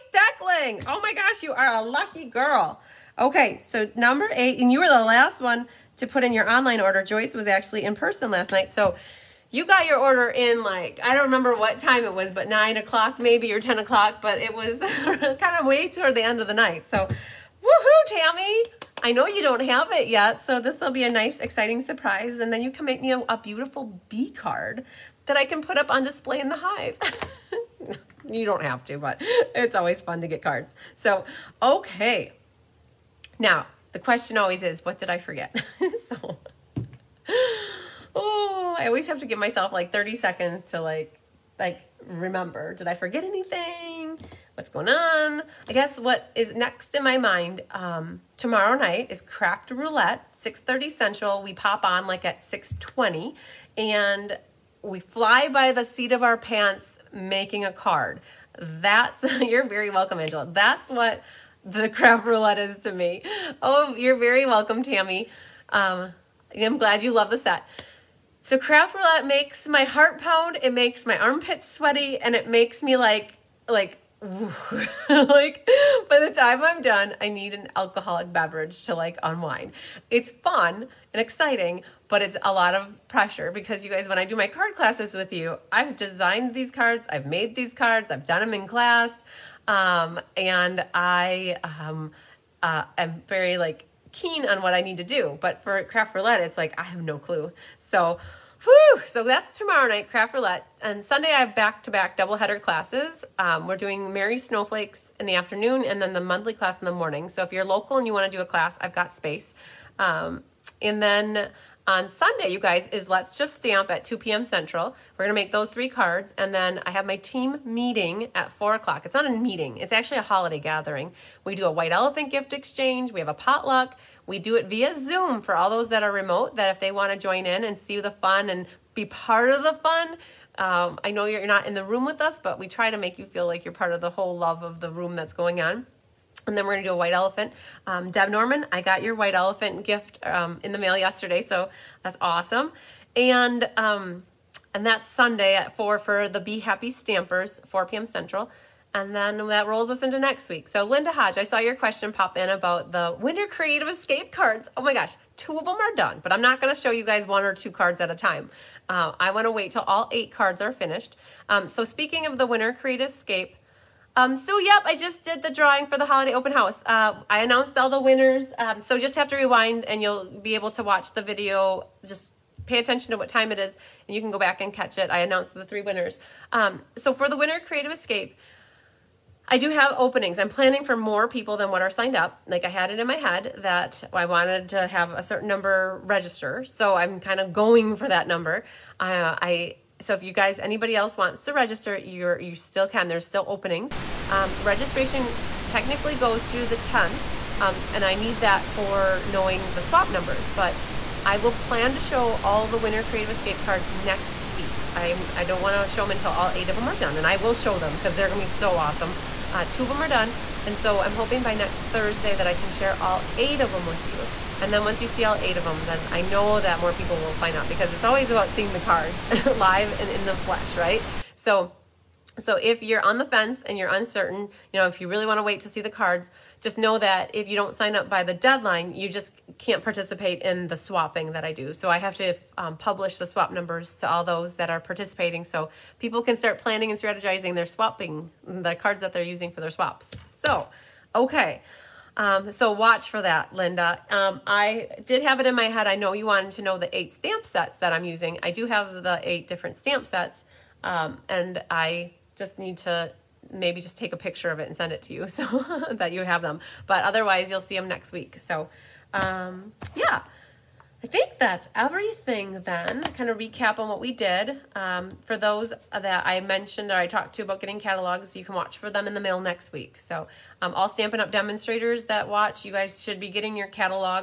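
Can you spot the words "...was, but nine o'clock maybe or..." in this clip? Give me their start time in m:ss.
0:12.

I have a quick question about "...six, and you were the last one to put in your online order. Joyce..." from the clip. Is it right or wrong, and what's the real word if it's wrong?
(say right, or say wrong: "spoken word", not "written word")
wrong: "eight", not "six".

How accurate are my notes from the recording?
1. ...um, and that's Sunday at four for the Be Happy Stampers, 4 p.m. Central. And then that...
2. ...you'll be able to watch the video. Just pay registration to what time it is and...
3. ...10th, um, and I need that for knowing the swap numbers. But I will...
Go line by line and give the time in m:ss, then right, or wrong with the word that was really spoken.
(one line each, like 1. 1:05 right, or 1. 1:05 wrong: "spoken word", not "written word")
1. 2:23 right
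2. 2:50 wrong: "attention", not "registration"
3. 3:16 right.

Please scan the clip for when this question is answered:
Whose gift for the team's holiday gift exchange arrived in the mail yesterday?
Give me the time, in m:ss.
2:18.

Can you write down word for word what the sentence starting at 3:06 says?
So I'm kind of going for that number.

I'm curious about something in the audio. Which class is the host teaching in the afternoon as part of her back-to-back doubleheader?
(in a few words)
Merry Snowflakes.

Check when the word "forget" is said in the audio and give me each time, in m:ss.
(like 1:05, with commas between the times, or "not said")
0:35, 0:42.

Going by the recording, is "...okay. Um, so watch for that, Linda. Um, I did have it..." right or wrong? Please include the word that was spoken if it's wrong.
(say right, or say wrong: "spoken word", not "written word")
right.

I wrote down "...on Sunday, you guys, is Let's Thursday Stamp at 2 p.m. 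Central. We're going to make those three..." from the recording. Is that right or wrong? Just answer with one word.
wrong.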